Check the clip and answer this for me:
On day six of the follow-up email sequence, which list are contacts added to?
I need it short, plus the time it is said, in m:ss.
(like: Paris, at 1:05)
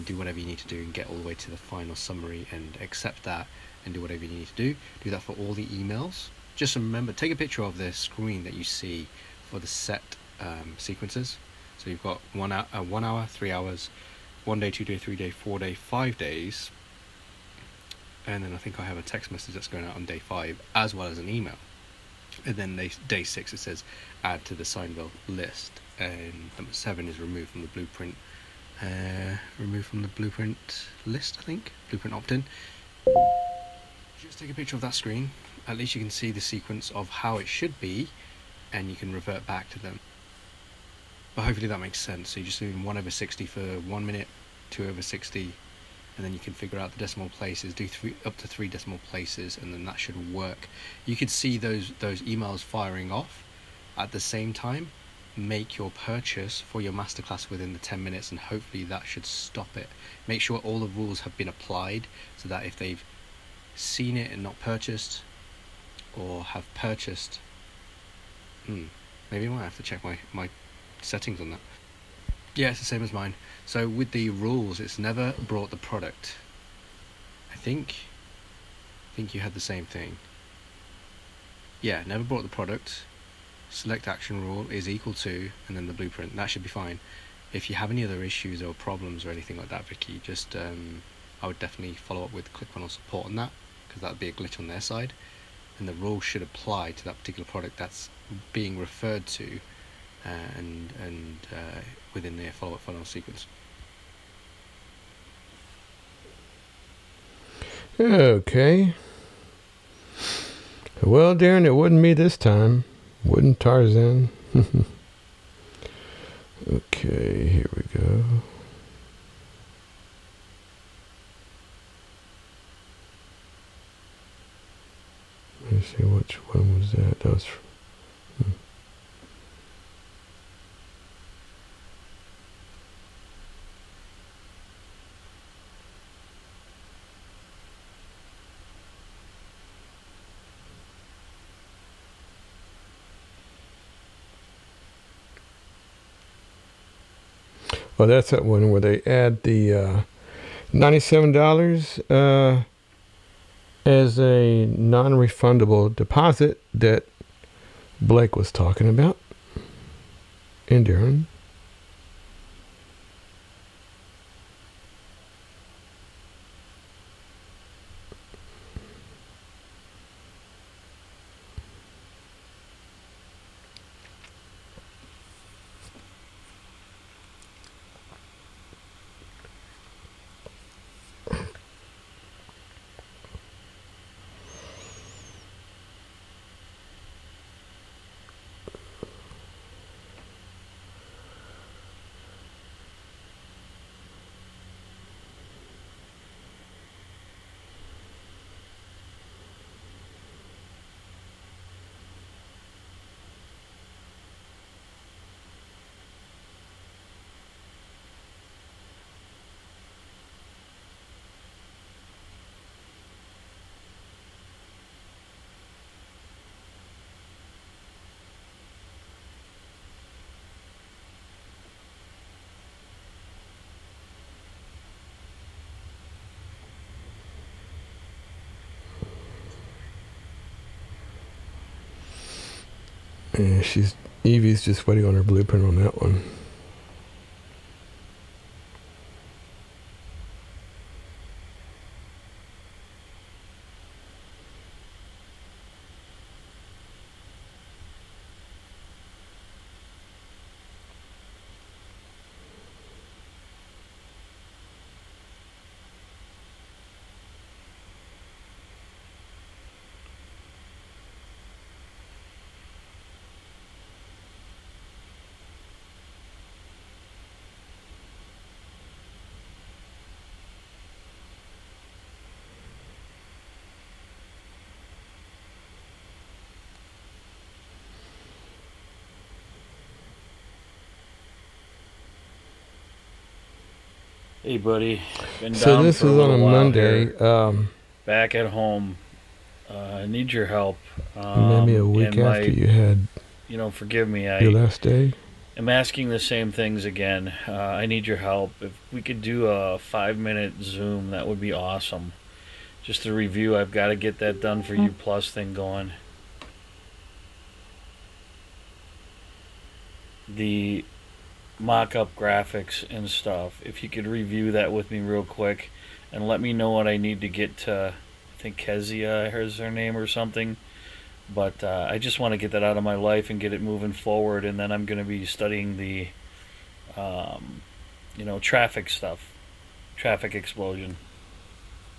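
Seinville list, at 0:24.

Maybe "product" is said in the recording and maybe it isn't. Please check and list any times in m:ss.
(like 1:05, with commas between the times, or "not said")
1:15, 1:22, 1:37.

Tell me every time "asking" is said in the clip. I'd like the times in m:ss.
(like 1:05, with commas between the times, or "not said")
4:55.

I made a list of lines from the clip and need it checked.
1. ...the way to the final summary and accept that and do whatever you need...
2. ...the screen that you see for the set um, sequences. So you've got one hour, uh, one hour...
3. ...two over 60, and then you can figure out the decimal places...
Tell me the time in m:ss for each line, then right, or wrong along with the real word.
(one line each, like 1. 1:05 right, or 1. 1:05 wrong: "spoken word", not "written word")
1. 0:01 right
2. 0:07 right
3. 0:44 right.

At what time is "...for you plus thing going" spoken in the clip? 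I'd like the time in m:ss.
5:04.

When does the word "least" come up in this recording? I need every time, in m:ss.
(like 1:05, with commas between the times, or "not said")
0:35.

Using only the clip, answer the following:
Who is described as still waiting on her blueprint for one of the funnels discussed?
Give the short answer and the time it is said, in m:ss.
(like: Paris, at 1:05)
Evie, at 3:54.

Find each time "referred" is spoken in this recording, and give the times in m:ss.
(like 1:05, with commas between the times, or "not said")
1:38.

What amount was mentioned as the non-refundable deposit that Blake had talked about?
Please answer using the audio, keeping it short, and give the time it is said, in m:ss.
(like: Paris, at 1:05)
$97, at 2:30.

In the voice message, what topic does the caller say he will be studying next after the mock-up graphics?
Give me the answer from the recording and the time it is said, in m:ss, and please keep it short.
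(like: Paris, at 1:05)
traffic explosion, at 5:29.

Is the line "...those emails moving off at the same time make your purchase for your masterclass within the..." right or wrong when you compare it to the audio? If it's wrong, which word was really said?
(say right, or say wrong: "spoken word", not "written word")
wrong: "firing", not "moving".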